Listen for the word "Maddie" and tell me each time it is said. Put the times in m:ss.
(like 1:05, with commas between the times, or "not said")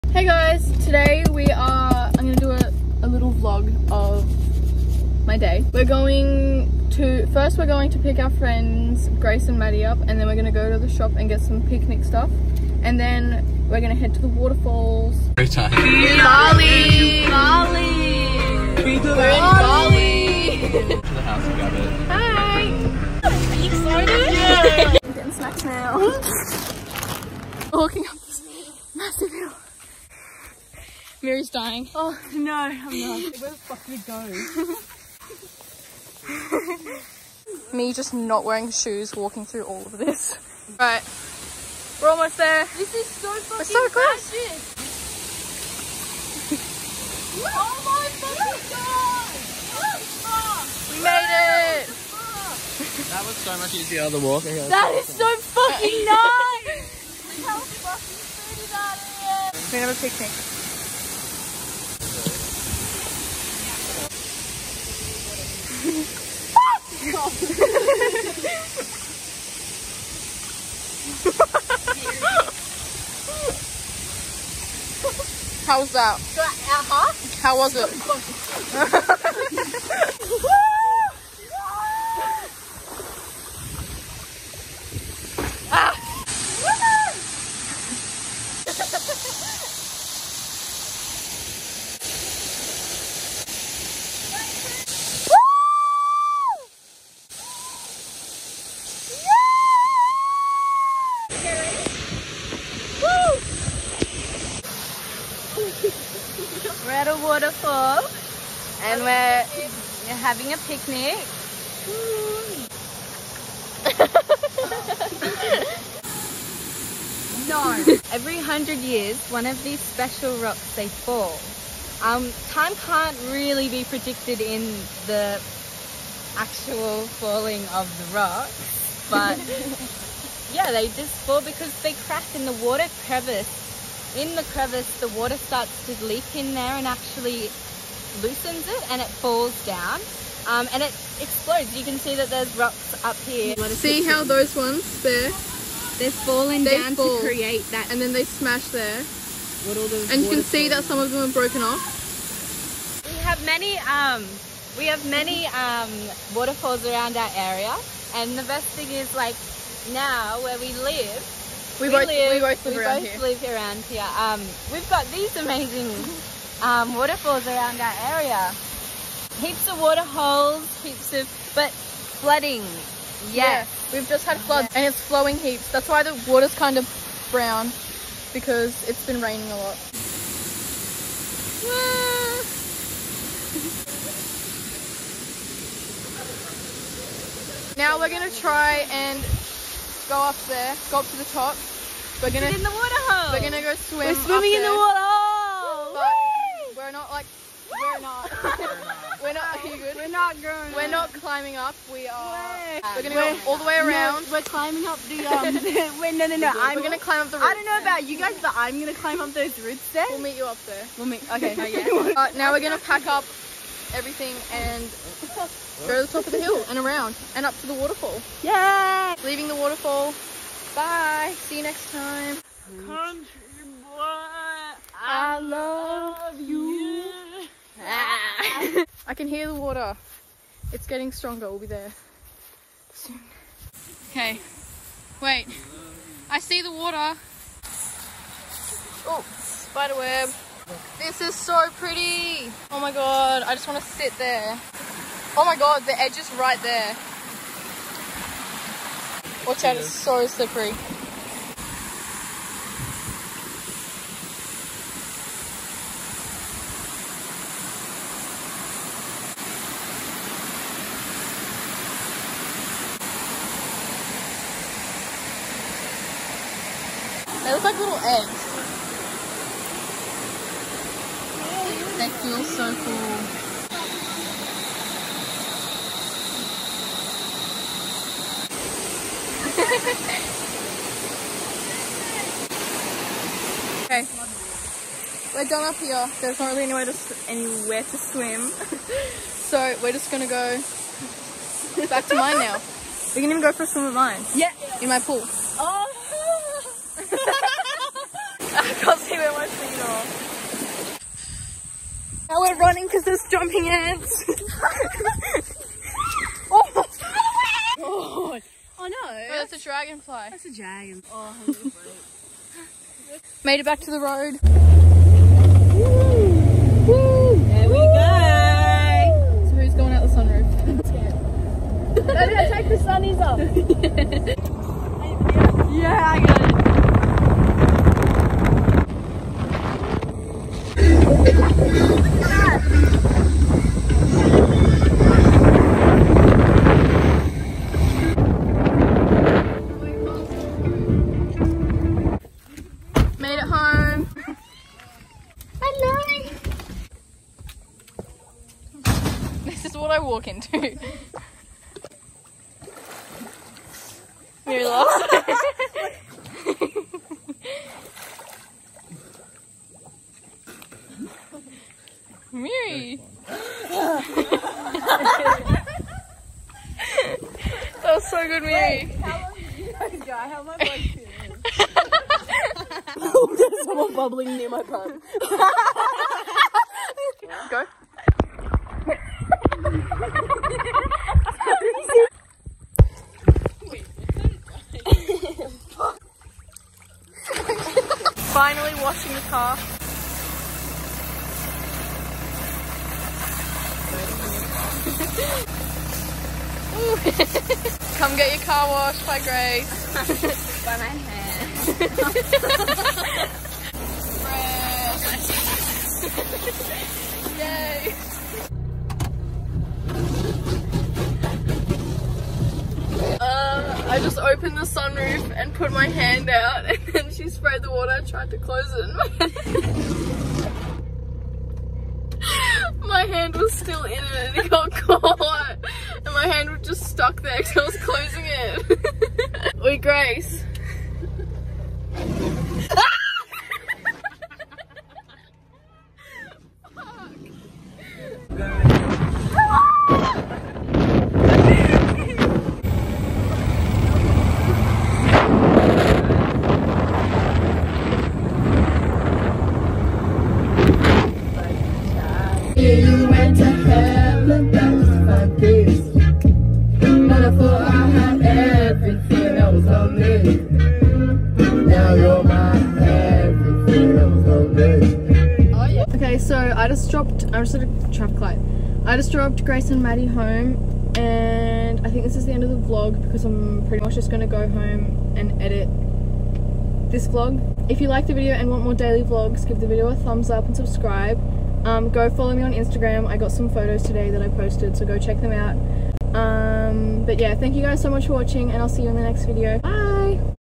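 0:09, 7:49.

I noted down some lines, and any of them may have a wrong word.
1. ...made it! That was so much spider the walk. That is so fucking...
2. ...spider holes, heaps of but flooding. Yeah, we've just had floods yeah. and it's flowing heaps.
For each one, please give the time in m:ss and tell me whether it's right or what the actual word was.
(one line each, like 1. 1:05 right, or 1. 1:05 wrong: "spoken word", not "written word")
1. 0:51 wrong: "easier", not "spider"
2. 2:49 wrong: "water", not "spider".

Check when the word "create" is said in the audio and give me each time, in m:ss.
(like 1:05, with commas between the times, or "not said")
2:27.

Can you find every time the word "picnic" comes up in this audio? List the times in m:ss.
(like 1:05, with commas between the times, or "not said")
0:11, 1:00, 1:50.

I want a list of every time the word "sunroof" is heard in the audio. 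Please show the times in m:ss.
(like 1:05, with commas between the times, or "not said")
5:20, 6:54.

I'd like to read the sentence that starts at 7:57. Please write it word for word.
If you like the video and want more daily vlogs, give the video a thumbs up and subscribe.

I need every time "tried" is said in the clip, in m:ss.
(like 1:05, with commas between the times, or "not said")
6:58.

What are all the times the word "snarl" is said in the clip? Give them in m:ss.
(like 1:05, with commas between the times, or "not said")
not said.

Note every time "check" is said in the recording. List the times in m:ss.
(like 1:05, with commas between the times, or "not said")
8:04.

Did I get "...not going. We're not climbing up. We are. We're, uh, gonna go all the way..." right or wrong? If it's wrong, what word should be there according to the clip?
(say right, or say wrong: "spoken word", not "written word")
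right.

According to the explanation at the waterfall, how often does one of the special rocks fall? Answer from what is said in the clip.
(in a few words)
Every hundred years.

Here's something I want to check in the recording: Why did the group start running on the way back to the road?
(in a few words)
Jumping ants.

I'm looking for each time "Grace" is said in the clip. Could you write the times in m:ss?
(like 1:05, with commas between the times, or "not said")
0:09, 6:39, 7:09, 7:49.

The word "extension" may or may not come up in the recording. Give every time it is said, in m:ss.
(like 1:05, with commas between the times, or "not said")
not said.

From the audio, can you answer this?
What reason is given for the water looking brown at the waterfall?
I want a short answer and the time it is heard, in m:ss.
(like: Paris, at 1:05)
Raining a lot, at 2:58.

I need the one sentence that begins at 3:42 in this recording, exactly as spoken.
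Country boy, I, I love, you.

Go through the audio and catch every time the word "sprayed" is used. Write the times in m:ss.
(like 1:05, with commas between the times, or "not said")
6:57.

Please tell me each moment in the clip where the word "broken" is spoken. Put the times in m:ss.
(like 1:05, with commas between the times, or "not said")
2:31.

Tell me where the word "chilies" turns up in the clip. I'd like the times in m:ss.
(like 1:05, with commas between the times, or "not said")
not said.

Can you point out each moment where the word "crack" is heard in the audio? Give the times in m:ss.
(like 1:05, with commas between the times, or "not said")
2:12.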